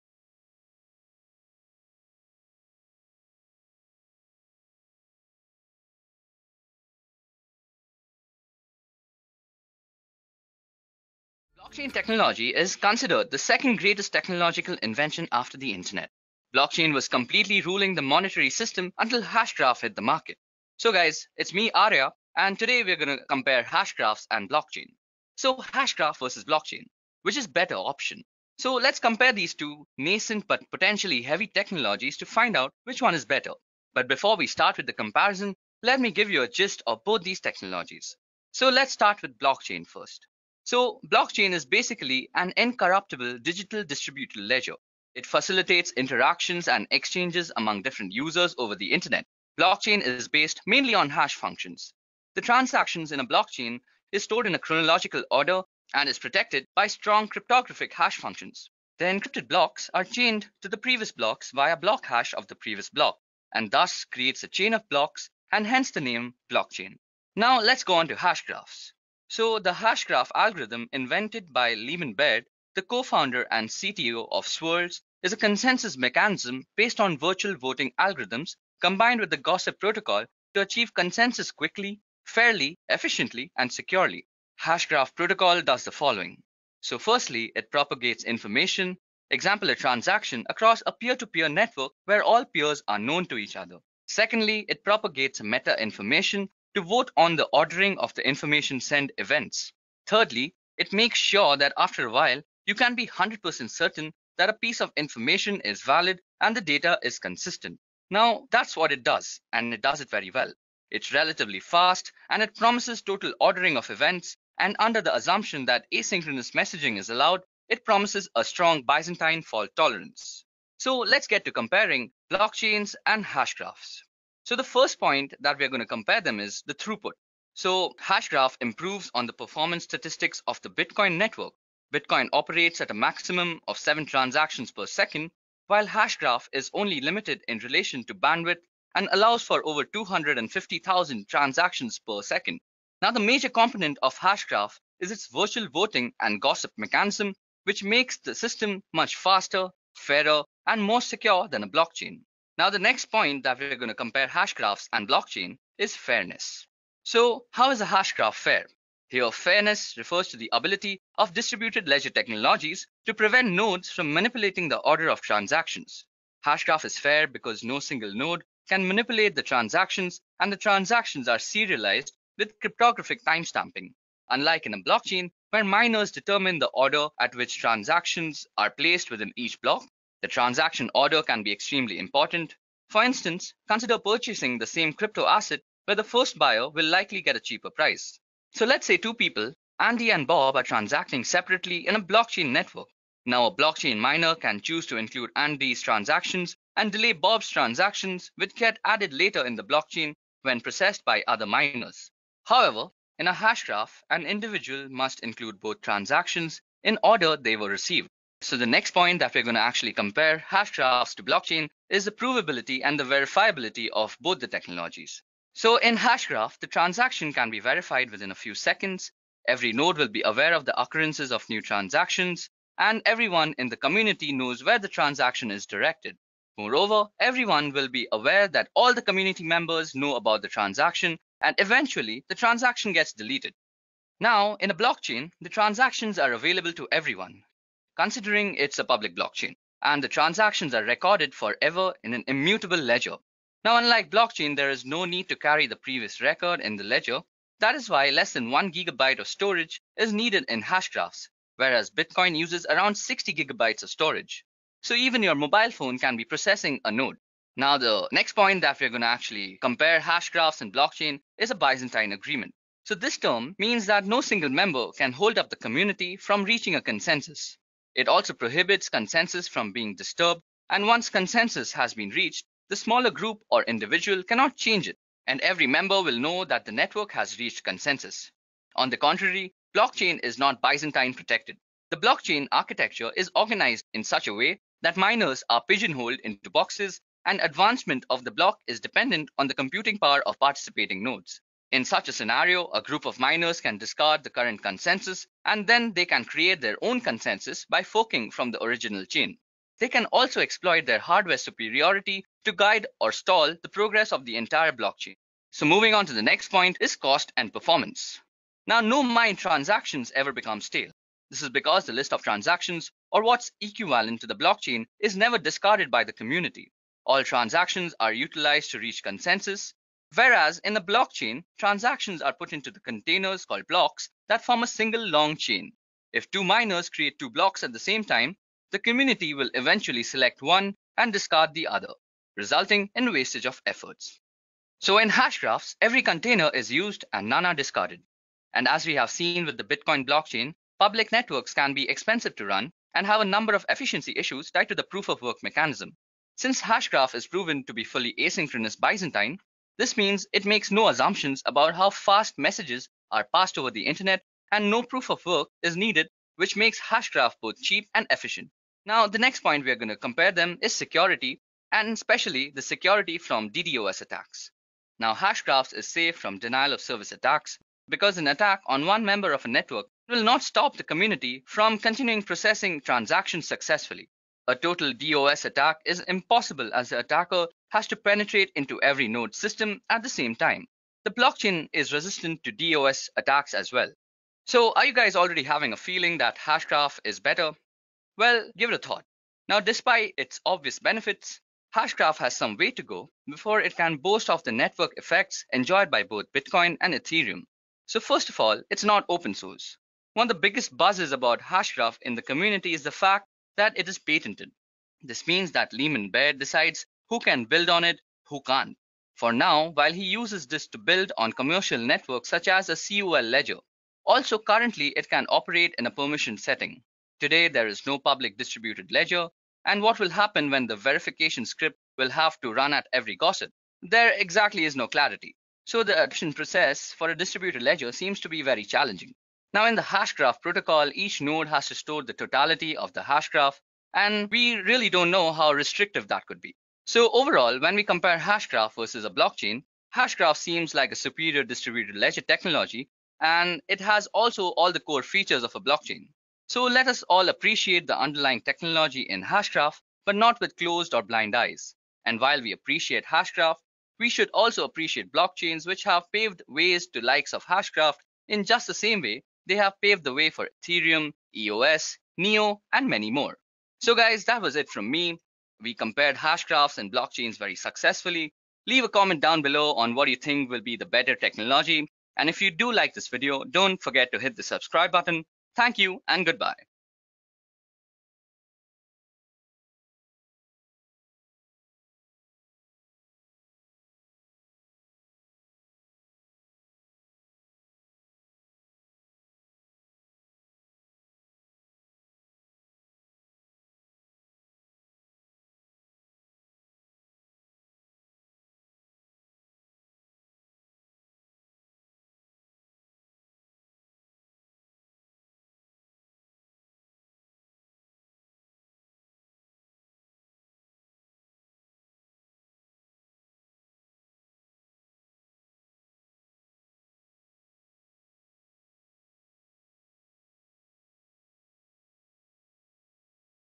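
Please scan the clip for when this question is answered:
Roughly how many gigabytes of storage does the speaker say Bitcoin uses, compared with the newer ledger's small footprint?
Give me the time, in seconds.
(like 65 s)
252 s.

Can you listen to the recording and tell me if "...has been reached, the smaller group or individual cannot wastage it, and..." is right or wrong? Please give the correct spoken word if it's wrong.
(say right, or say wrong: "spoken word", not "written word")
wrong: "change", not "wastage".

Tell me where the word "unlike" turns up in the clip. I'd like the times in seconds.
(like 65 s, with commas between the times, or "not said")
174 s, 243 s.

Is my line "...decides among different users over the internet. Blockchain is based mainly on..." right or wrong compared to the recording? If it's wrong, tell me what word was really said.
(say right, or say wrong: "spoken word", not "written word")
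wrong: "exchanges", not "decides".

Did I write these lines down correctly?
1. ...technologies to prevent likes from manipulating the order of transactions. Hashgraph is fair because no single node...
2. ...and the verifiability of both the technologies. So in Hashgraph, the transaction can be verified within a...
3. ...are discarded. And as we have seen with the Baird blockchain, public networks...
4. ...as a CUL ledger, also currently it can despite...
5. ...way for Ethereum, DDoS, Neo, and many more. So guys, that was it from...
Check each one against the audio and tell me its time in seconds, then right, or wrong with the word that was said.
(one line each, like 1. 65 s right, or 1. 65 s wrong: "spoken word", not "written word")
1. 162 s wrong: "nodes", not "likes"
2. 212 s right
3. 337 s wrong: "Bitcoin", not "Baird"
4. 412 s wrong: "operate", not "despite"
5. 460 s wrong: "EOS", not "DDoS".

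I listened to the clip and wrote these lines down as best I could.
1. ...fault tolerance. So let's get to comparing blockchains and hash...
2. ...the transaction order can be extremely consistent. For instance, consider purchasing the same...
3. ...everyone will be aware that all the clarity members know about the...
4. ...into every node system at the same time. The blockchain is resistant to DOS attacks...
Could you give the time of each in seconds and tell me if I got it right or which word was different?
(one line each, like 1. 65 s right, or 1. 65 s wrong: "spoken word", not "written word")
1. 119 s right
2. 180 s wrong: "important", not "consistent"
3. 227 s wrong: "community", not "clarity"
4. 378 s right.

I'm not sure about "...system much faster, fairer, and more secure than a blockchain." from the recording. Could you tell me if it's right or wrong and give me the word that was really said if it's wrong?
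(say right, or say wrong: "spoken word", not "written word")
right.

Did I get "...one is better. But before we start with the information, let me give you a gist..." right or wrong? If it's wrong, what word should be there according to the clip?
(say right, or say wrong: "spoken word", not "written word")
wrong: "comparison", not "information".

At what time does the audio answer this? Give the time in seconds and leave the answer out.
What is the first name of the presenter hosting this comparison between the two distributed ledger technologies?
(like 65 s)
21 s.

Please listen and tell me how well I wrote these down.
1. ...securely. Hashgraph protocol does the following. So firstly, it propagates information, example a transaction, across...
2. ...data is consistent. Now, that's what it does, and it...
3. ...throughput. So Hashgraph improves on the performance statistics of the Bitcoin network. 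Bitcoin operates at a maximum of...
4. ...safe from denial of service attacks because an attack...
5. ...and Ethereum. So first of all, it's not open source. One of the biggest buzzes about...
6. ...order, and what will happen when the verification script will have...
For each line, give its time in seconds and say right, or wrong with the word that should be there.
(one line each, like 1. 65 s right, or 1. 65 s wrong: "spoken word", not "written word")
1. 83 s right
2. 106 s right
3. 126 s right
4. 365 s right
5. 396 s right
6. 418 s wrong: "ledger", not "order".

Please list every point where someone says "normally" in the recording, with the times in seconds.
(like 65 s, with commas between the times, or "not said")
not said.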